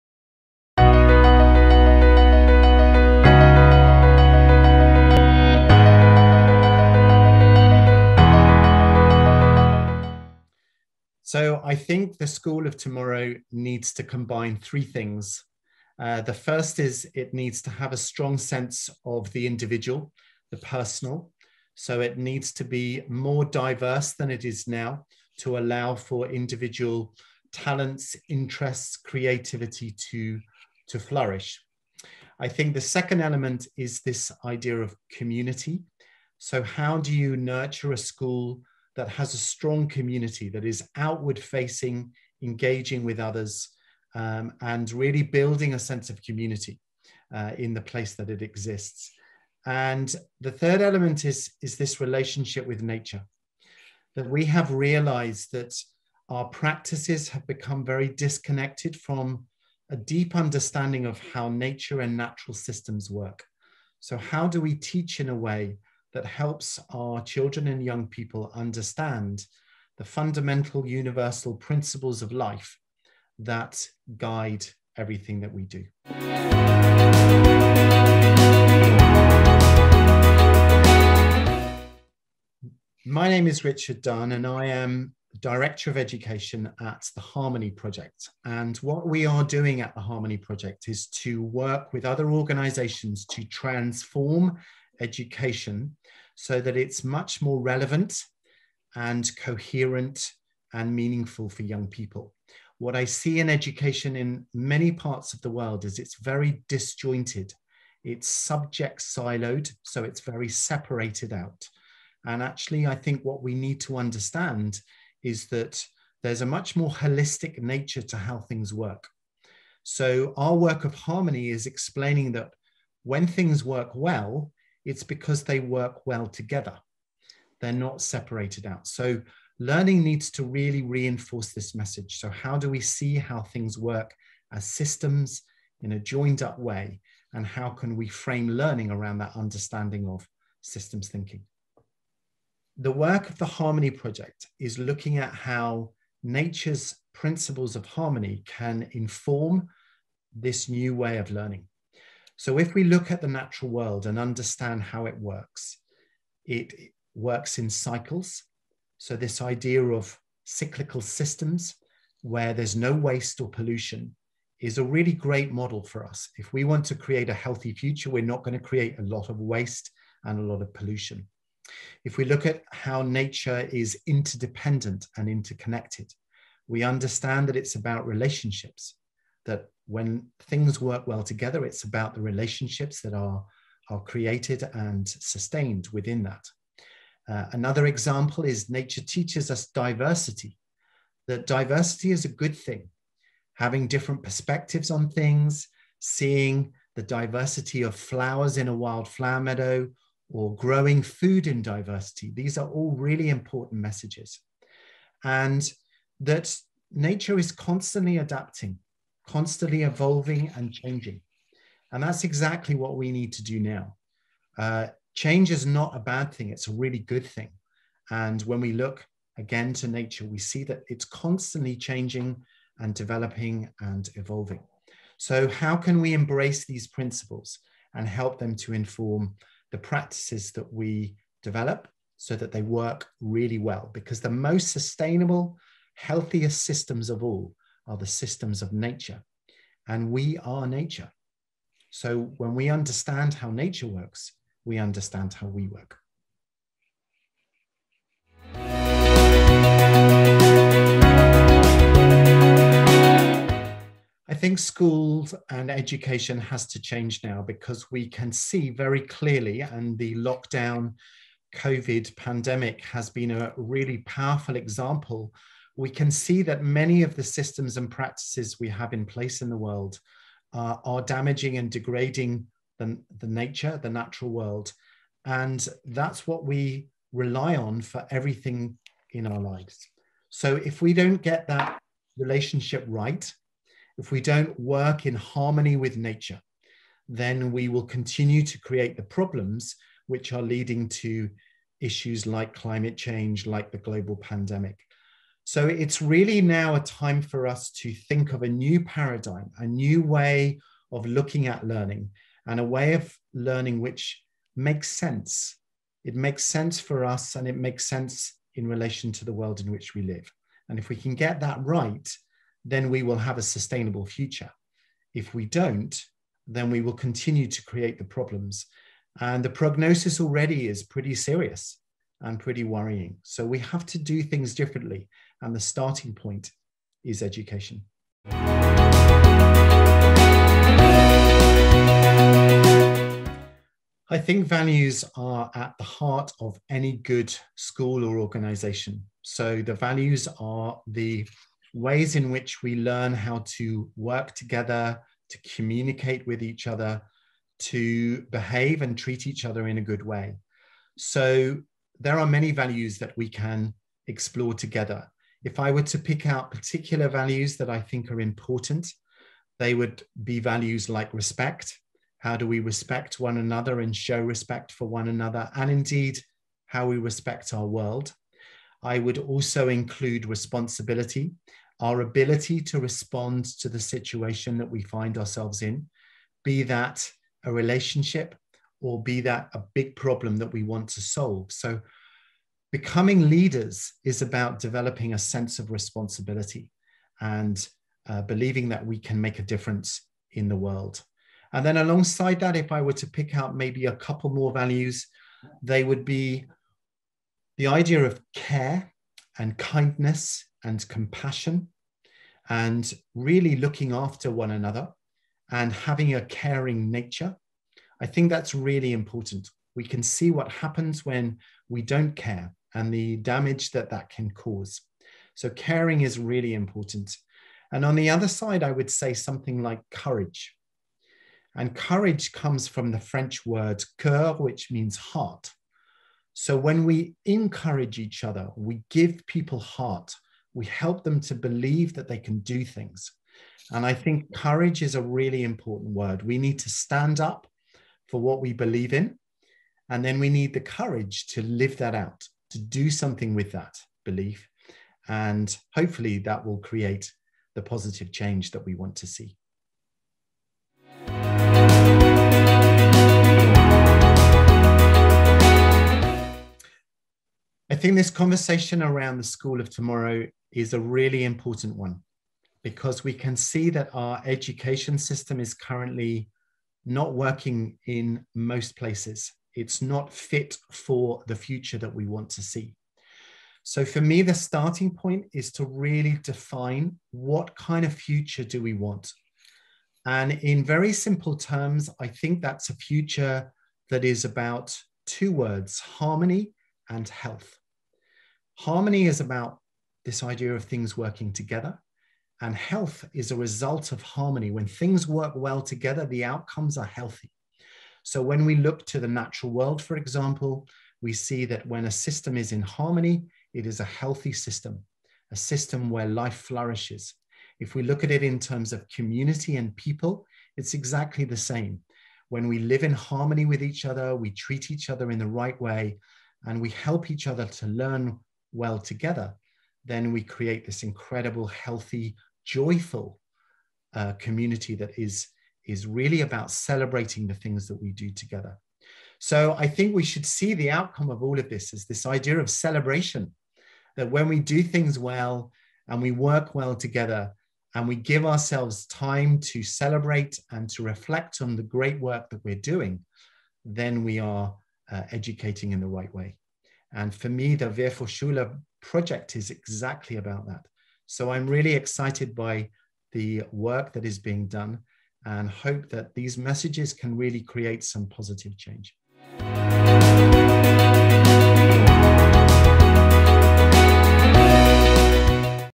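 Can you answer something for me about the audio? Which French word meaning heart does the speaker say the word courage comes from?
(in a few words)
cœur.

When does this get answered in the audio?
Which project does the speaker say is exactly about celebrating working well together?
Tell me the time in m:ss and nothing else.
9:07.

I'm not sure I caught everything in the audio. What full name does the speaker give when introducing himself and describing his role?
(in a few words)
Richard Dunne.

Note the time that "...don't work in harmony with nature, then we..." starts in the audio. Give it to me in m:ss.
4:44.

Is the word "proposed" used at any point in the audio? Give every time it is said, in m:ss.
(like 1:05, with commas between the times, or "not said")
not said.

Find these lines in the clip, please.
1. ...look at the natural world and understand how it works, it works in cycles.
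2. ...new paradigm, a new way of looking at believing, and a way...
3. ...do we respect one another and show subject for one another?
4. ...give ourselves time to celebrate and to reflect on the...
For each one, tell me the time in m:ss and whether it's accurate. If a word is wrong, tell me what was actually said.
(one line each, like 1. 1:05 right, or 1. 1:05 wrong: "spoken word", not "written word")
1. 2:32 right
2. 4:58 wrong: "learning", not "believing"
3. 6:02 wrong: "respect", not "subject"
4. 8:57 right.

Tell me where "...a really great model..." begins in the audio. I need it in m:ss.
2:44.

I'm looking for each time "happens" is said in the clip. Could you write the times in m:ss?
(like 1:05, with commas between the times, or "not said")
6:50.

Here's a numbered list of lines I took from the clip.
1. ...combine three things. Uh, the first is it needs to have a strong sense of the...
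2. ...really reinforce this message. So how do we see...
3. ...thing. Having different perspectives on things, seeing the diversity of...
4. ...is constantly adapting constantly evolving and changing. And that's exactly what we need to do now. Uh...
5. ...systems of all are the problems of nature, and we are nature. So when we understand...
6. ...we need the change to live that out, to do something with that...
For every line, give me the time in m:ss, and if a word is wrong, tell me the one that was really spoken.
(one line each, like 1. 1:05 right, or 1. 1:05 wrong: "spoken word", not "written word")
1. 0:14 right
2. 2:10 right
3. 3:12 right
4. 3:27 right
5. 3:56 wrong: "systems", not "problems"
6. 7:20 wrong: "courage", not "change".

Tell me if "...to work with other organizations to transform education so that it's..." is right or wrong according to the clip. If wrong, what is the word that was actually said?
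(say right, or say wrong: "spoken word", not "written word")
right.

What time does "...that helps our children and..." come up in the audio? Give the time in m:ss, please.
1:06.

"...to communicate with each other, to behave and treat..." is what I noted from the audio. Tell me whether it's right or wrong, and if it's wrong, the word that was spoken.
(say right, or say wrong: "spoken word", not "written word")
right.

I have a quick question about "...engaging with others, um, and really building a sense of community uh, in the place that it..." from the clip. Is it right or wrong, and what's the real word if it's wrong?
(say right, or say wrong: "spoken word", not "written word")
right.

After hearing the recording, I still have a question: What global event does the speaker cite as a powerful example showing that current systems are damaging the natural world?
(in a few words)
COVID pandemic.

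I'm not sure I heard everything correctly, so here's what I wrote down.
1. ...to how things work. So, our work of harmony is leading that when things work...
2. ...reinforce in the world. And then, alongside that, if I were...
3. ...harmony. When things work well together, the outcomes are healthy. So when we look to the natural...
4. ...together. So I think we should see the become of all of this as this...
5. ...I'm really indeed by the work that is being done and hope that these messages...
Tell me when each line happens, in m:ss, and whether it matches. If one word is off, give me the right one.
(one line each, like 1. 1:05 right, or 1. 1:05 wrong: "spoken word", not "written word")
1. 1:58 wrong: "explaining", not "leading"
2. 6:29 wrong: "difference", not "reinforce"
3. 8:14 right
4. 8:48 wrong: "outcome", not "become"
5. 9:11 wrong: "excited", not "indeed".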